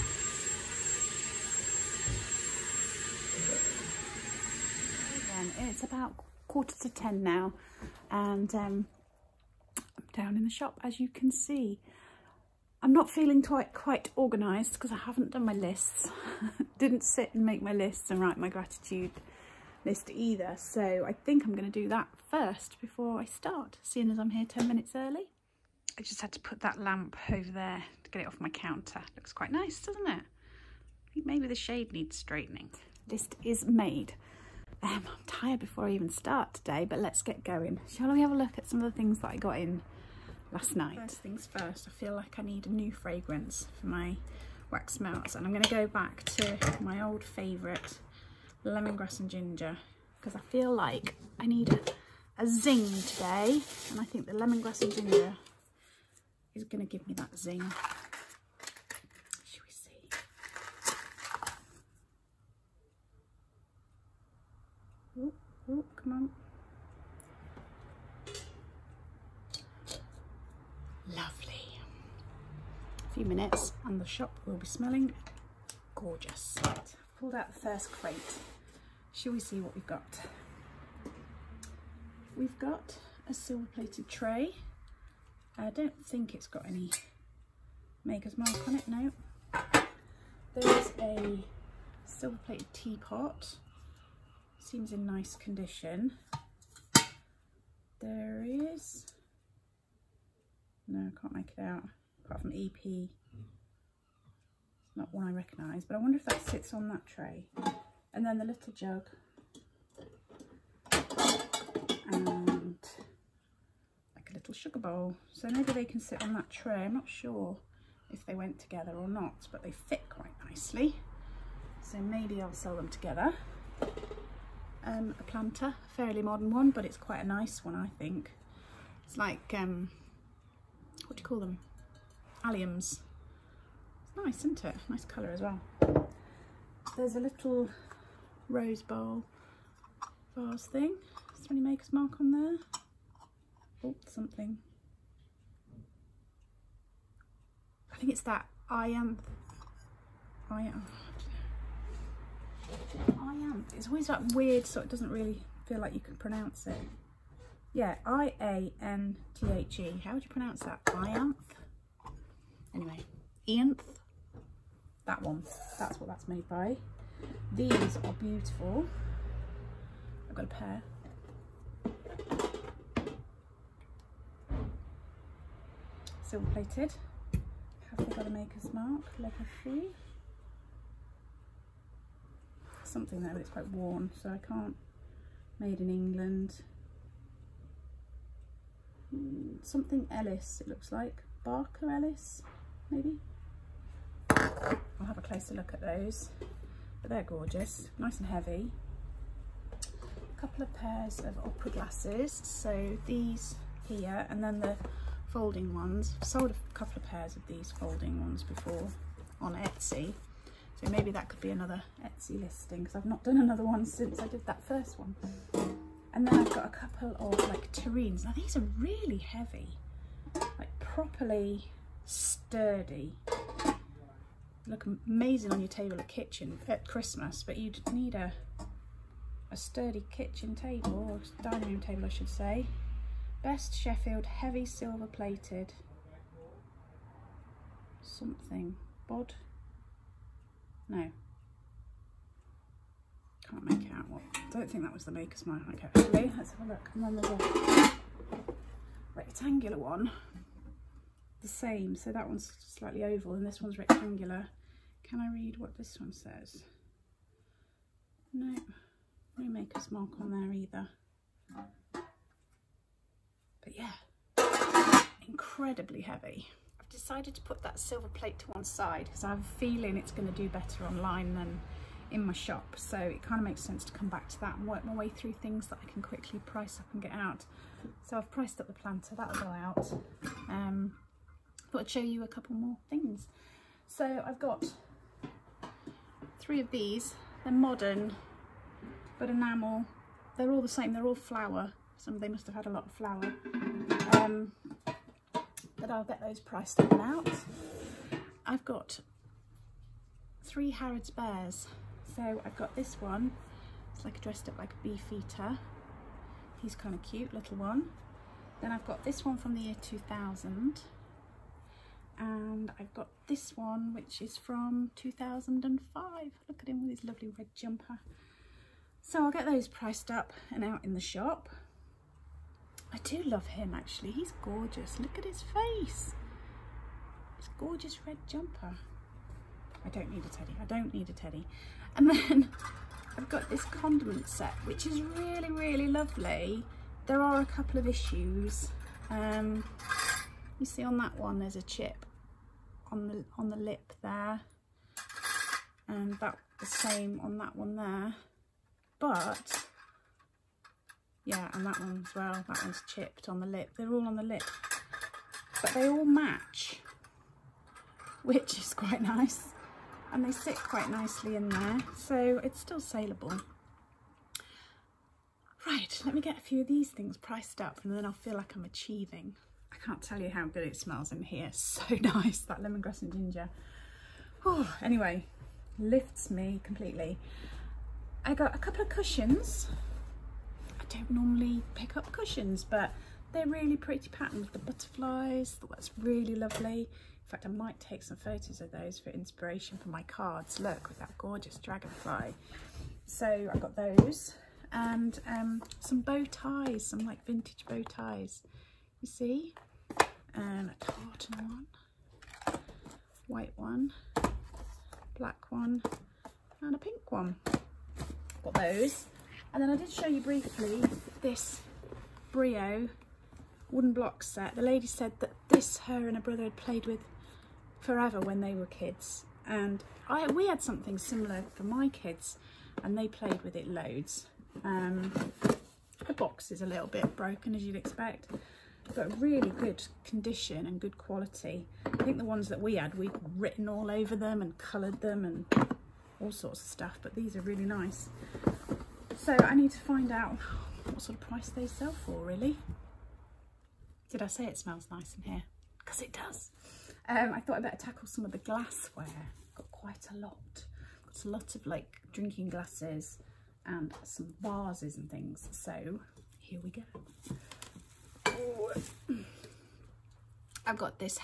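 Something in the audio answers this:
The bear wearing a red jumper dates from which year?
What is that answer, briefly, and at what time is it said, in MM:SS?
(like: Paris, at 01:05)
2005, at 05:14.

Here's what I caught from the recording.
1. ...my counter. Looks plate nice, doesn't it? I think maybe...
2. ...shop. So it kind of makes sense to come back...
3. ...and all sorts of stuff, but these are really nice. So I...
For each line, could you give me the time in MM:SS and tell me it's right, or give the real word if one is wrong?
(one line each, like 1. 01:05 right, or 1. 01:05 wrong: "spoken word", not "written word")
1. 00:28 wrong: "quite", not "plate"
2. 04:32 right
3. 07:15 right.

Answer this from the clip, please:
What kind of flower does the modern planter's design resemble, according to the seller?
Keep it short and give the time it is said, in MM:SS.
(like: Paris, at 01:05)
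alliums, at 02:12.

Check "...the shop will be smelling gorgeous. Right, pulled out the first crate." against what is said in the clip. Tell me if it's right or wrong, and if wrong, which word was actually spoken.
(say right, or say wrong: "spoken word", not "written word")
right.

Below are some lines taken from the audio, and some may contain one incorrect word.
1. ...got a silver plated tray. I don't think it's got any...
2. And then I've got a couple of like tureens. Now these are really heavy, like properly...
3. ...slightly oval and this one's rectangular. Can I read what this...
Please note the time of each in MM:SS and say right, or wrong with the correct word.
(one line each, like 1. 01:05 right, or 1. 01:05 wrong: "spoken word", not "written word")
1. 01:22 right
2. 03:36 right
3. 04:12 right.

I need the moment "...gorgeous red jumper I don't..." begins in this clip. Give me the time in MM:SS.
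05:27.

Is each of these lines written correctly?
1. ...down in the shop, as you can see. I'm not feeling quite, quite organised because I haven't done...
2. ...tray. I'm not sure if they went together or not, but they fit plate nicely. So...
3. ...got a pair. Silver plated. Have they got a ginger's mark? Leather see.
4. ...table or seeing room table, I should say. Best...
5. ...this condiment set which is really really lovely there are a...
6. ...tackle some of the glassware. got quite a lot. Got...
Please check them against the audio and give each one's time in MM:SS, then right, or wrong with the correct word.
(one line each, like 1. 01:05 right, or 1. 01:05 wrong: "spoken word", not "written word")
1. 00:10 right
2. 01:56 wrong: "quite", not "plate"
3. 02:50 wrong: "maker", not "ginger"
4. 03:50 wrong: "dining", not "seeing"
5. 05:33 right
6. 07:27 right.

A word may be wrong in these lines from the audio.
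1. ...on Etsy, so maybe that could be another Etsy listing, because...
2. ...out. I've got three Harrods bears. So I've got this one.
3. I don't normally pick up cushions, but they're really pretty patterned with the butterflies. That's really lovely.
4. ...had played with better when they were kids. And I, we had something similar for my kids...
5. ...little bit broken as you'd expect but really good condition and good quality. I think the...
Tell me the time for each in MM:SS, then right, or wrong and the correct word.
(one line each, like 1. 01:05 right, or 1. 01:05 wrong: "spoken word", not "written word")
1. 03:29 right
2. 04:57 right
3. 06:20 right
4. 06:56 wrong: "forever", not "better"
5. 07:06 right.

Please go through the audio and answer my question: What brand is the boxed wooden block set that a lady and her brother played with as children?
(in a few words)
Brio.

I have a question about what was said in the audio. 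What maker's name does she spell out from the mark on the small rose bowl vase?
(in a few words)
IANTHE.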